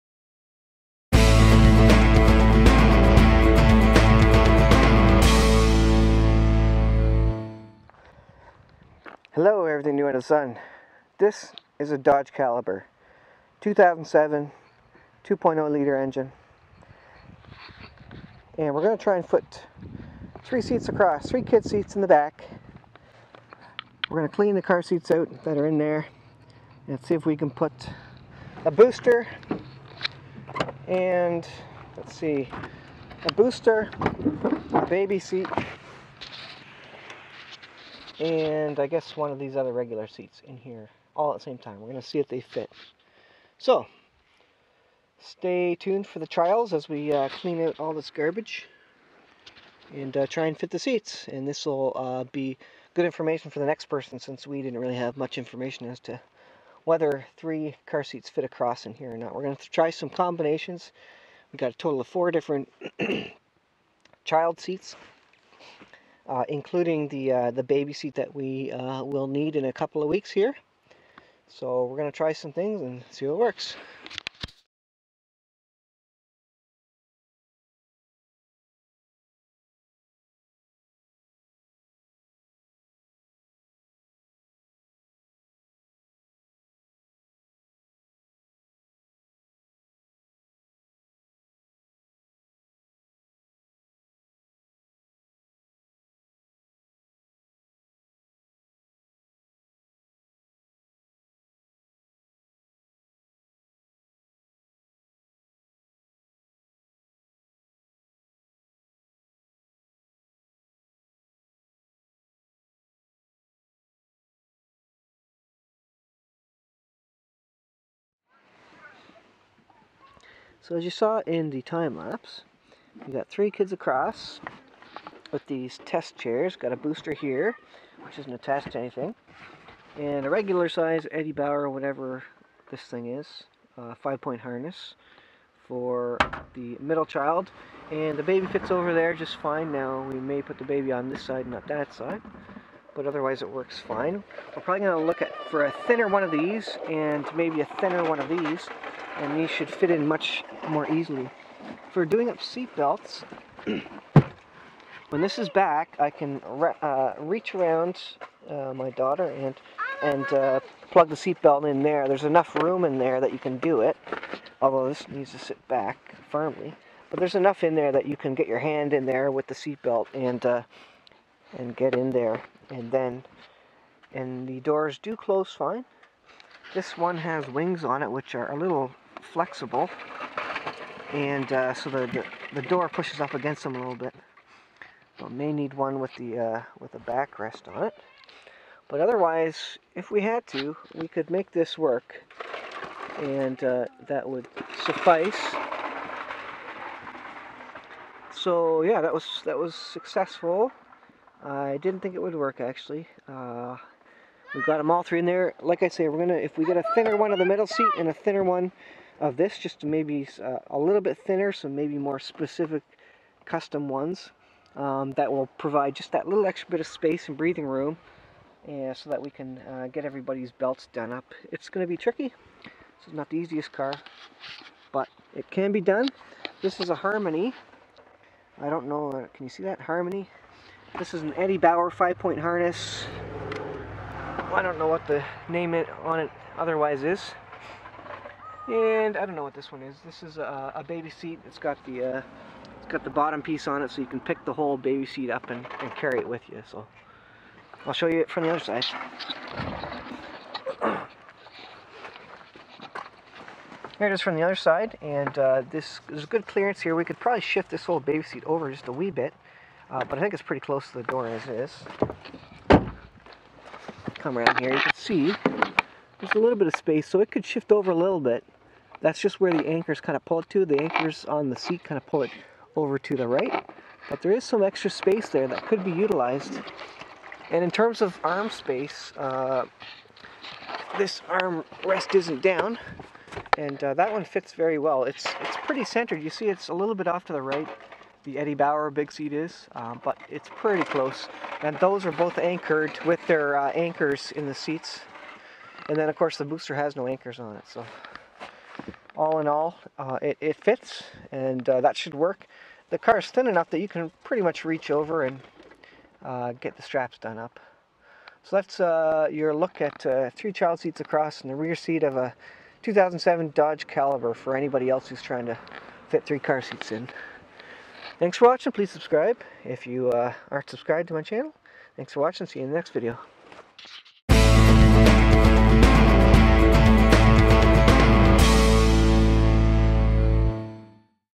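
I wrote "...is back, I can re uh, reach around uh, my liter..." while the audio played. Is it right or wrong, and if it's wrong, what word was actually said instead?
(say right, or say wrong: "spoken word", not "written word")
wrong: "daughter", not "liter".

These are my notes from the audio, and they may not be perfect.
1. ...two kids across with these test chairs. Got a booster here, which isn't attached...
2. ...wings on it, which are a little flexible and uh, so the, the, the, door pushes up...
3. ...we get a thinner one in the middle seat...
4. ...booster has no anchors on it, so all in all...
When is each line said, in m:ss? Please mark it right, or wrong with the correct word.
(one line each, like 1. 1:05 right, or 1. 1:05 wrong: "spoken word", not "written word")
1. 2:03 wrong: "three", not "two"
2. 2:57 right
3. 3:26 right
4. 4:56 right.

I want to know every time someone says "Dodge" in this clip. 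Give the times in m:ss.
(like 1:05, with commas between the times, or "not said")
0:11, 5:13.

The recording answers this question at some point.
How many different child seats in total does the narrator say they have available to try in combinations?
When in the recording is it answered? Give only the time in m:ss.
1:02.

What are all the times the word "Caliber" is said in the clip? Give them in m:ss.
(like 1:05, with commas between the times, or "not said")
0:12, 5:13.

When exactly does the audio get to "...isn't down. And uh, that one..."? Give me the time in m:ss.
4:42.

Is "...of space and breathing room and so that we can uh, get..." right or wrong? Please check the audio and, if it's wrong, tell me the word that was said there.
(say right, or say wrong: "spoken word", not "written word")
right.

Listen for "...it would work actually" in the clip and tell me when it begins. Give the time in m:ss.
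3:22.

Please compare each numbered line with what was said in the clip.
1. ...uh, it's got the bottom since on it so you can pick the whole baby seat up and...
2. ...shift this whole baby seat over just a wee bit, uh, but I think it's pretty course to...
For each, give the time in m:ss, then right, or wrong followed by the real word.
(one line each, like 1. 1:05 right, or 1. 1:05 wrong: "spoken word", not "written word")
1. 4:02 wrong: "piece", not "since"
2. 4:17 wrong: "close", not "course".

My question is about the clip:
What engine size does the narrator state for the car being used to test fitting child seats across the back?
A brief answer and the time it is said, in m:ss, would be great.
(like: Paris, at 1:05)
2.0 liter, at 0:15.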